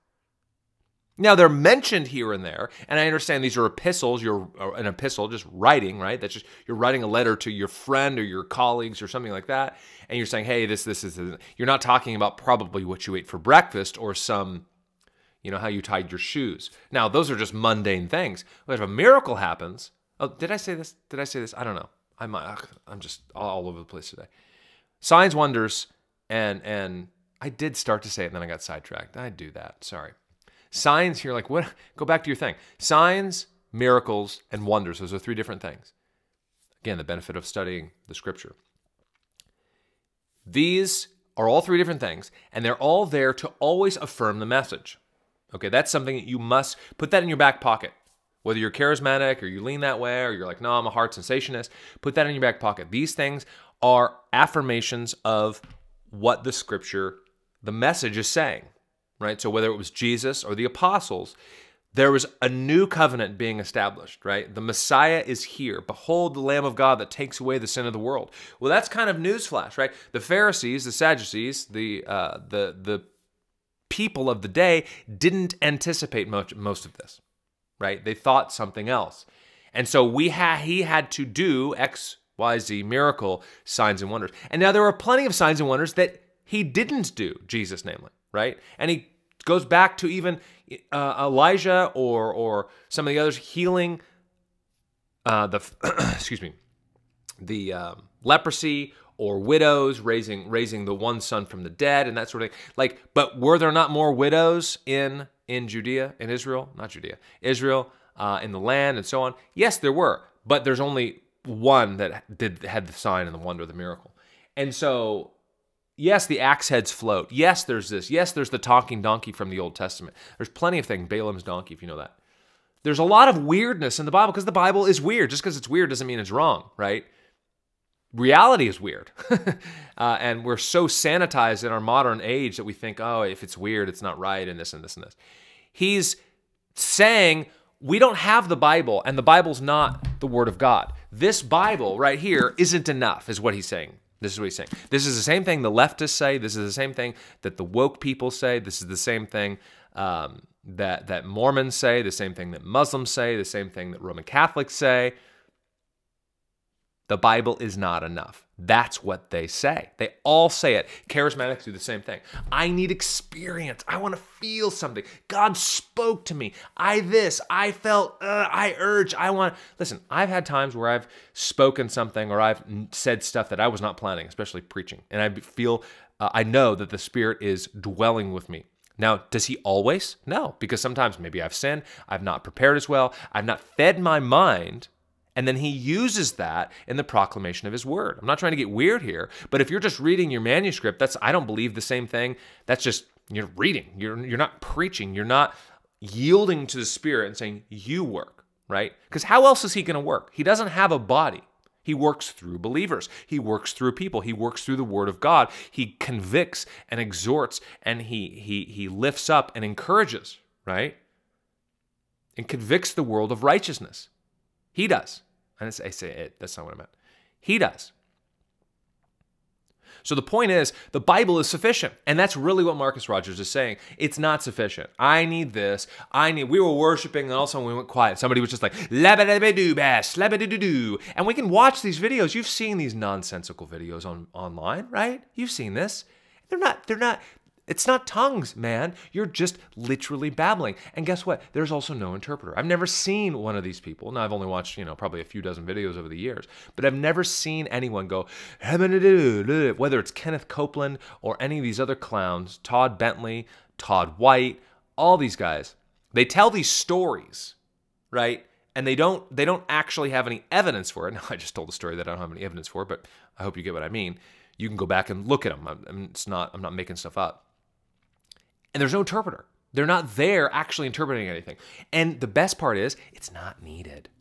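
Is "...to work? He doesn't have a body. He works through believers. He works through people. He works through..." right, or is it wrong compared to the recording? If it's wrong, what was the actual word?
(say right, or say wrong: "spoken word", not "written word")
right.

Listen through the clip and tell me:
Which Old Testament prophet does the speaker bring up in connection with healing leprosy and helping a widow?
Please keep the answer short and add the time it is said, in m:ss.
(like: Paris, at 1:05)
Elijah, at 1:31.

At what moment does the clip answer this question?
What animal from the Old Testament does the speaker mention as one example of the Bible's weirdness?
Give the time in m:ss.
2:01.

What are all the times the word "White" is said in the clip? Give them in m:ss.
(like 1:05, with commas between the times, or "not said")
4:14.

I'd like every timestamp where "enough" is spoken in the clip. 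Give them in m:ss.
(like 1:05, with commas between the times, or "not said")
2:22, 2:38.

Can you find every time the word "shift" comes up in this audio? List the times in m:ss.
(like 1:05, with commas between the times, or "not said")
not said.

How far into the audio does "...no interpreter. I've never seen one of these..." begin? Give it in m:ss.
4:01.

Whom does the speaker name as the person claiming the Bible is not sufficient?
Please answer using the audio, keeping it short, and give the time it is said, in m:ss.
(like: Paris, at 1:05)
Marcus Rogers, at 3:42.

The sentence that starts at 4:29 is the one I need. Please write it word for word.
They're not there actually interpreting anything.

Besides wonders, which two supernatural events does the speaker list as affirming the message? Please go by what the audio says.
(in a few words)
Signs, miracles.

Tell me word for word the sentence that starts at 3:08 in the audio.
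I'm not trying to get weird here, but if you're just reading your manuscript, that's I don't believe the same thing.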